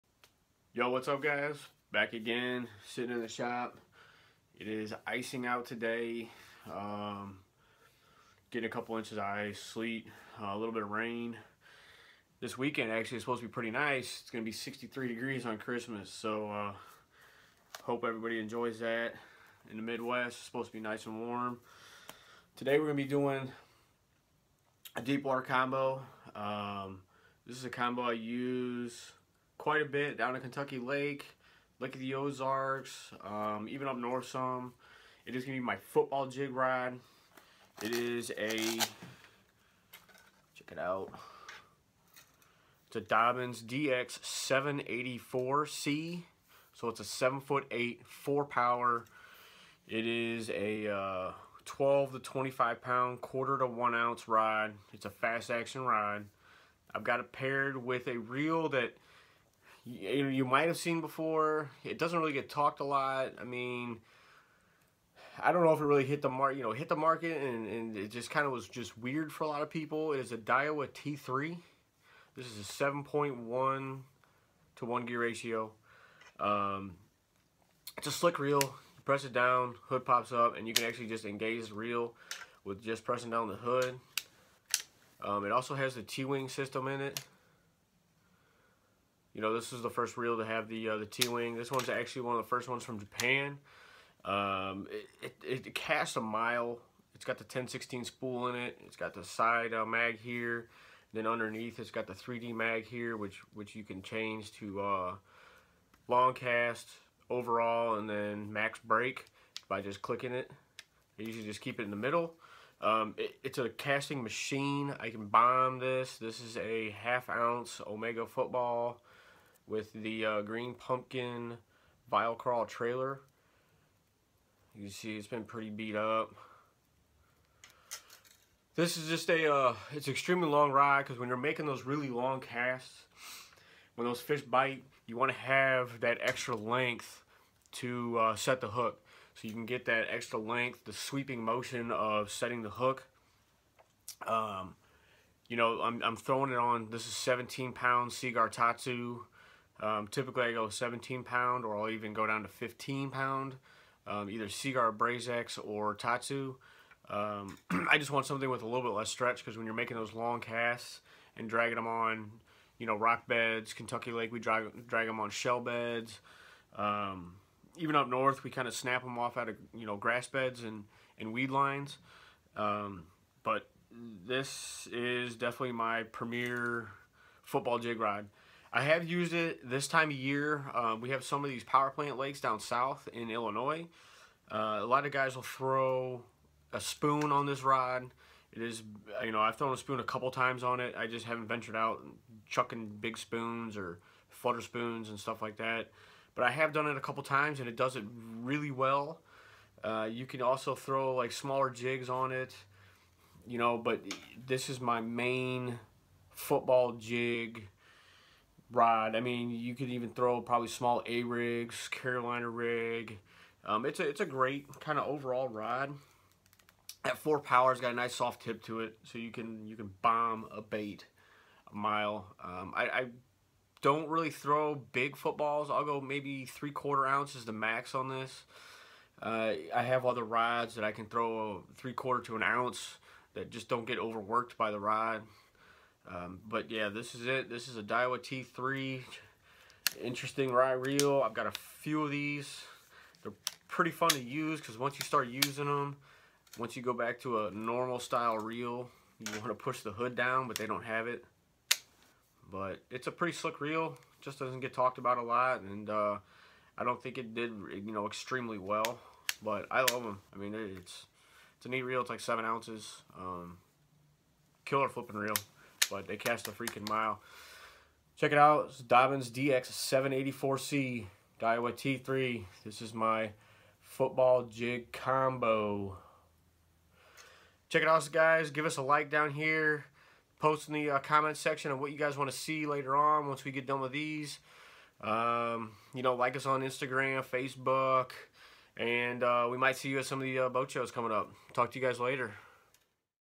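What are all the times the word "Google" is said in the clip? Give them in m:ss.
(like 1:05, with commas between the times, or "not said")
not said.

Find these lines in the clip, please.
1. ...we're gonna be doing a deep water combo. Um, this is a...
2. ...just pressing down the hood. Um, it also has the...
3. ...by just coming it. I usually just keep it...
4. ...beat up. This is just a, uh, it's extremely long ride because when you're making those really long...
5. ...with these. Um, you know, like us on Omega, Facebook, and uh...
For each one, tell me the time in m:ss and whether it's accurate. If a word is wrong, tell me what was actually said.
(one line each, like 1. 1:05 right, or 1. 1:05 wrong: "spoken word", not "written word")
1. 0:22 right
2. 1:22 right
3. 1:49 wrong: "clicking", not "coming"
4. 2:05 right
5. 4:43 wrong: "Instagram", not "Omega".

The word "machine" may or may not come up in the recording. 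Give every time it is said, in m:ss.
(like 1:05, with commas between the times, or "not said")
1:54.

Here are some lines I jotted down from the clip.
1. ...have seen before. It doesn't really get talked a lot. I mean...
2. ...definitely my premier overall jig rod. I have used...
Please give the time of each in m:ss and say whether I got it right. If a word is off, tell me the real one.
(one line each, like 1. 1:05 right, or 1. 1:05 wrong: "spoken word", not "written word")
1. 1:00 right
2. 2:55 wrong: "football", not "overall".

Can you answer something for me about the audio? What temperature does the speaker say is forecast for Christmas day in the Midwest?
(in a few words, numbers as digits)
63 degrees.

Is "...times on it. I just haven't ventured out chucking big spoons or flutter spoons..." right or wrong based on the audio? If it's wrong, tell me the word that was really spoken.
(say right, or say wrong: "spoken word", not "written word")
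right.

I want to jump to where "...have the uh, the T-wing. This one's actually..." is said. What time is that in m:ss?
1:30.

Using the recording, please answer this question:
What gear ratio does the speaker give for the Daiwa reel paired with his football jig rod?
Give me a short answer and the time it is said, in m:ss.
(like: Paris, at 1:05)
7.1 to 1, at 1:12.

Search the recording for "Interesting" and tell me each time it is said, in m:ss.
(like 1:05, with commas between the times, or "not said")
4:00.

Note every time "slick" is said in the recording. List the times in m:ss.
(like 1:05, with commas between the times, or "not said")
1:18, 4:13.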